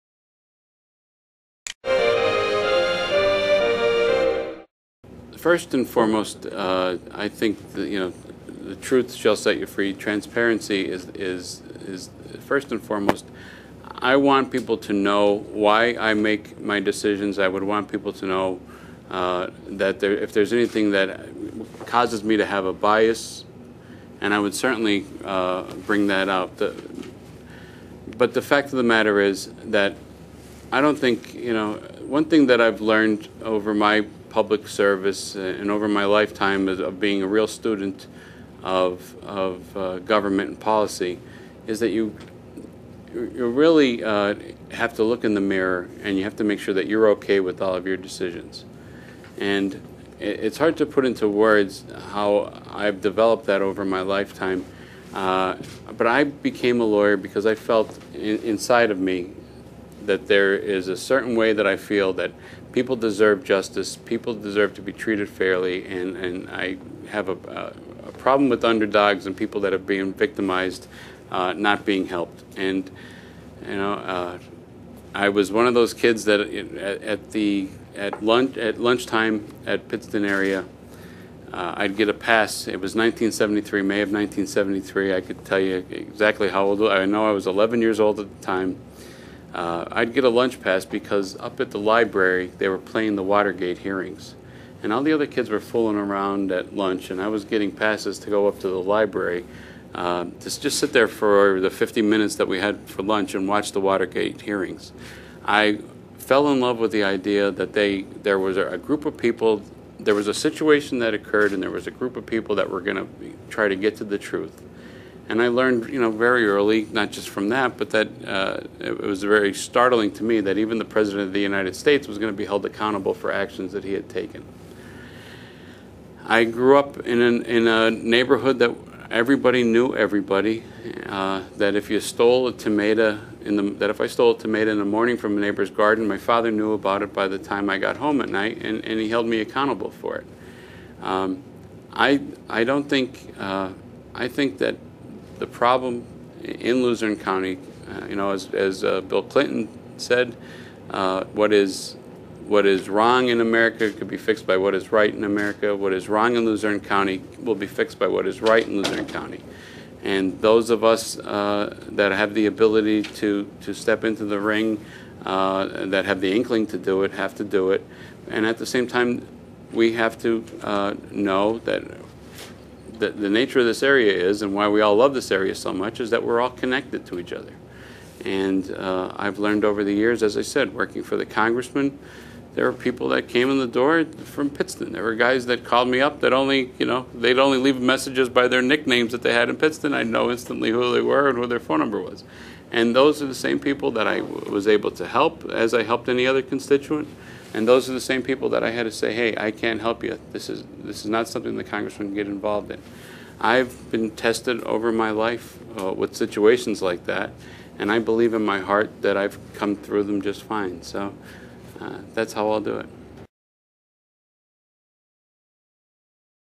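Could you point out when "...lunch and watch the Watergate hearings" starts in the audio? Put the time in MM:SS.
01:43.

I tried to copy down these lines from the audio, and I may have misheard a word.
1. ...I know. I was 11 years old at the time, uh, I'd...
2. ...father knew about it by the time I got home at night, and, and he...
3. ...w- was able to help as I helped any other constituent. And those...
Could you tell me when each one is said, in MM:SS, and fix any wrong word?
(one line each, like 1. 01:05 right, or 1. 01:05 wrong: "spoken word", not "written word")
1. 01:26 right
2. 02:16 right
3. 03:14 right.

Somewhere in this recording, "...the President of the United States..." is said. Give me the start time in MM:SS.
02:00.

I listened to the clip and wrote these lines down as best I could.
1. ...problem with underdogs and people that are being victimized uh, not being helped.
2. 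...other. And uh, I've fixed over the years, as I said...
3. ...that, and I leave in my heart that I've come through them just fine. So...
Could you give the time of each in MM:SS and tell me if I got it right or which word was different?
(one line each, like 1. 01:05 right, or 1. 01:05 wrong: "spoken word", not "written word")
1. 01:08 right
2. 02:57 wrong: "learned", not "fixed"
3. 03:27 wrong: "believe", not "leave".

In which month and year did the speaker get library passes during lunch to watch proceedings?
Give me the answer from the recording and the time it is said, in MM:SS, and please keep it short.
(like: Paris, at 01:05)
May 1973, at 01:23.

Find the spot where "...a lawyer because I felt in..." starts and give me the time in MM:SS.
00:56.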